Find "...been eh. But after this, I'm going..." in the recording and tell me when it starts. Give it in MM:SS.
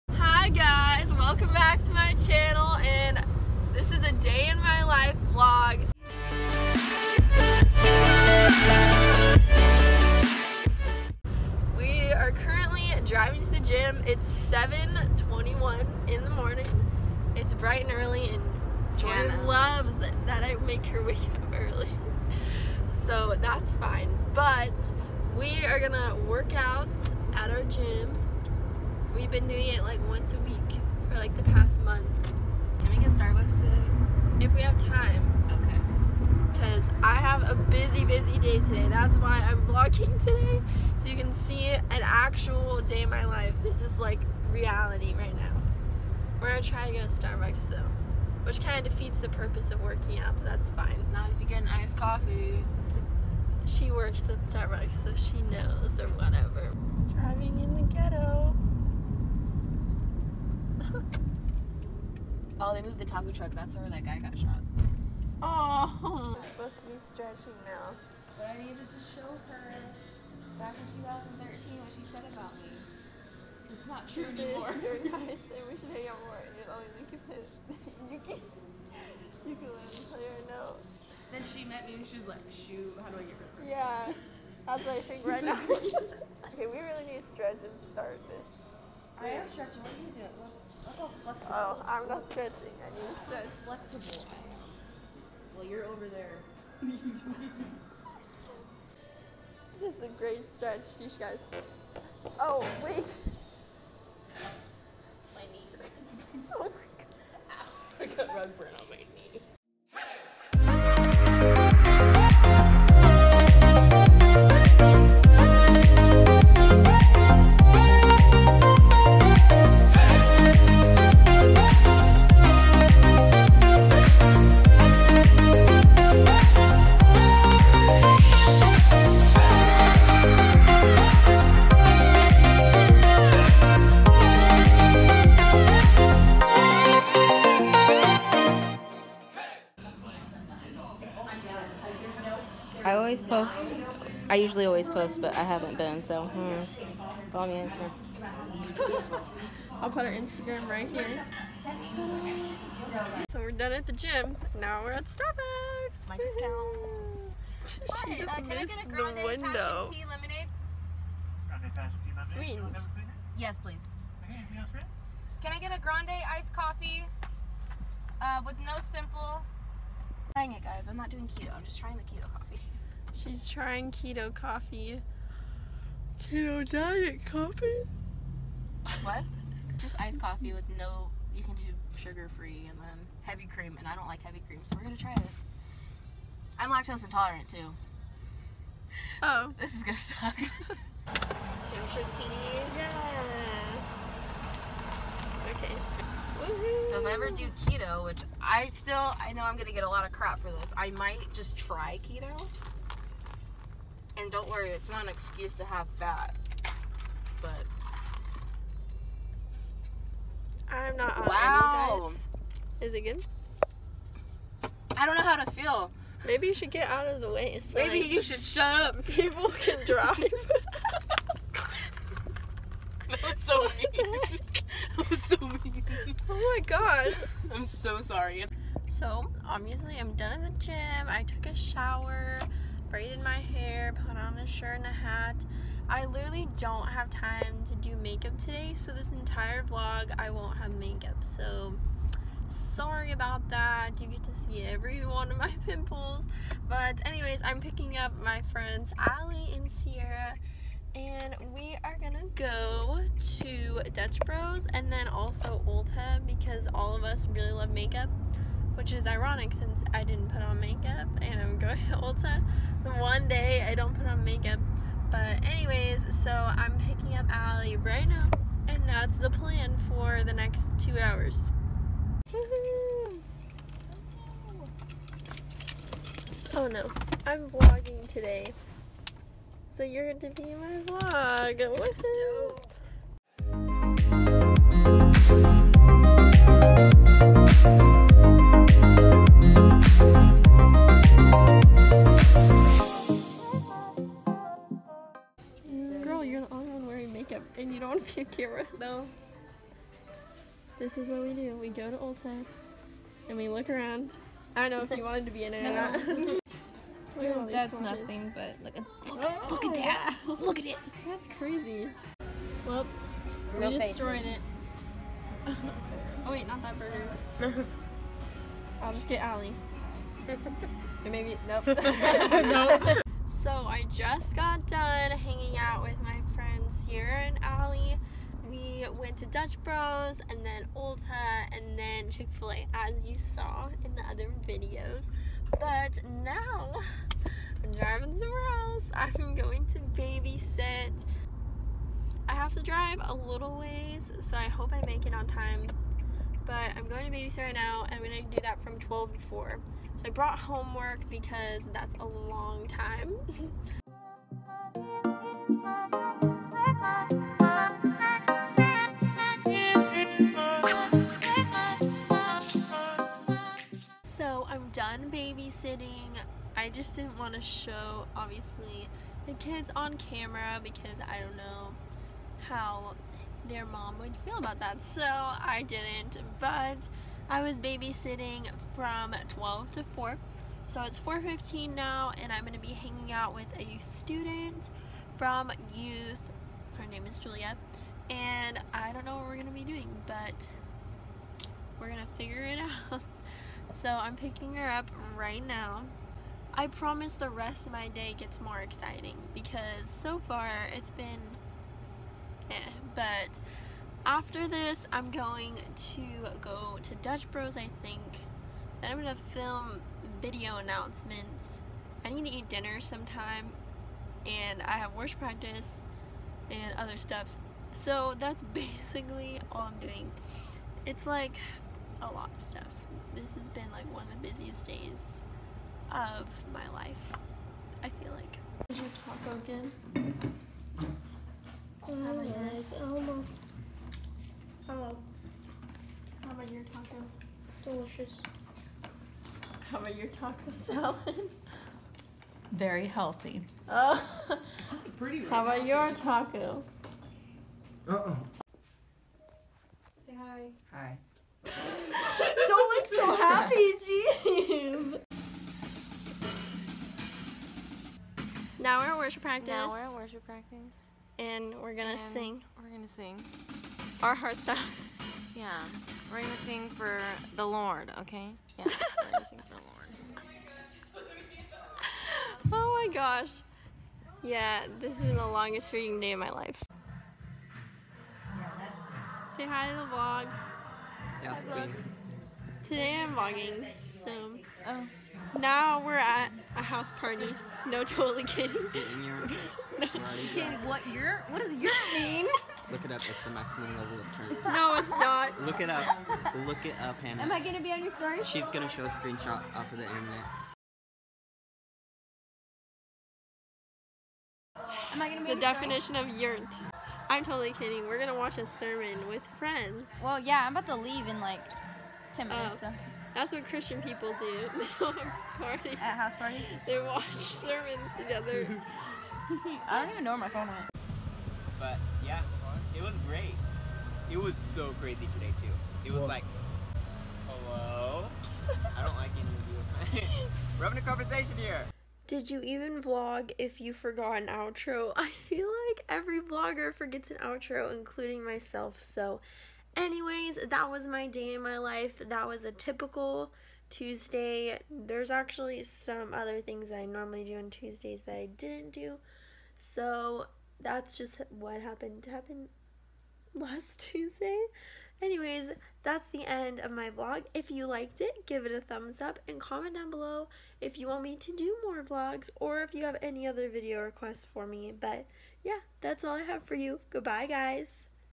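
06:40.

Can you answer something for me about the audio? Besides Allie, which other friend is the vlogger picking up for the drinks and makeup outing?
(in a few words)
Sierra.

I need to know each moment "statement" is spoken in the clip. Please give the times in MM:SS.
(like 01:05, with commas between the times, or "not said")
not said.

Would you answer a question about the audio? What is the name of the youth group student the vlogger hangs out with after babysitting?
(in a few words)
Julia.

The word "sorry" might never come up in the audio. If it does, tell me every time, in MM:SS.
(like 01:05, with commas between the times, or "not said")
03:47, 04:02.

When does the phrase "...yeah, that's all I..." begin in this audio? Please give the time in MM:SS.
09:25.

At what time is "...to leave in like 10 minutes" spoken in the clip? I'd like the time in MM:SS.
08:30.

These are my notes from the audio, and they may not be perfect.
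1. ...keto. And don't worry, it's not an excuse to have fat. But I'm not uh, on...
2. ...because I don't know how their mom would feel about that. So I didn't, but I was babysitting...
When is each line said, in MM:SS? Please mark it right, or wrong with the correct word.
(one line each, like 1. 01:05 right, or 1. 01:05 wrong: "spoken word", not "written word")
1. 03:22 right
2. 06:10 right.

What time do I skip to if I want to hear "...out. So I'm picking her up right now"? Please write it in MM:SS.
06:32.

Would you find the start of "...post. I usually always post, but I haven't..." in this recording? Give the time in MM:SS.
02:23.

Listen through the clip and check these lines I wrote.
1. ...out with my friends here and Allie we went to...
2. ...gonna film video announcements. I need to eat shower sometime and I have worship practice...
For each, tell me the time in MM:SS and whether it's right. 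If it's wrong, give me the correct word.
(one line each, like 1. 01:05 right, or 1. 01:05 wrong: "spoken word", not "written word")
1. 05:25 right
2. 06:48 wrong: "dinner", not "shower".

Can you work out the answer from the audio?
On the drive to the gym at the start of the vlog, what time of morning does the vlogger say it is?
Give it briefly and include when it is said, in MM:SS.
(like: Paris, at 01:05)
7:21, at 00:14.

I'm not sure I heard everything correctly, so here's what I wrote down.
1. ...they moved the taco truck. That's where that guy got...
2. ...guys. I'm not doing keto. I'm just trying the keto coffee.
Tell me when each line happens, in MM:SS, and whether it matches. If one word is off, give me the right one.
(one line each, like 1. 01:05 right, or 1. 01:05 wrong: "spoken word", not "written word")
1. 01:02 right
2. 02:50 right.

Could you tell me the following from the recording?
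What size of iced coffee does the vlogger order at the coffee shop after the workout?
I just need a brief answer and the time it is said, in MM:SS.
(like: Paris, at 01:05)
Grande, at 02:45.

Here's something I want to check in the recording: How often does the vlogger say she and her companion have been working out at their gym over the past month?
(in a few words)
Once a week.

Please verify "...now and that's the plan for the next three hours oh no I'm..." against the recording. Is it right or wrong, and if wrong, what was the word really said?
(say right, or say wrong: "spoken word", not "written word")
wrong: "two", not "three".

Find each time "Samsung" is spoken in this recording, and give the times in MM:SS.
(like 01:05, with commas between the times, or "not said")
not said.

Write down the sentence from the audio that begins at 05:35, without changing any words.
But now I'm driving somewhere else.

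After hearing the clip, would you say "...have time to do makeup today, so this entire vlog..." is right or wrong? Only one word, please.
right.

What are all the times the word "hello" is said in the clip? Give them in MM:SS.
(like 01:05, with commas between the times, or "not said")
07:14, 08:47.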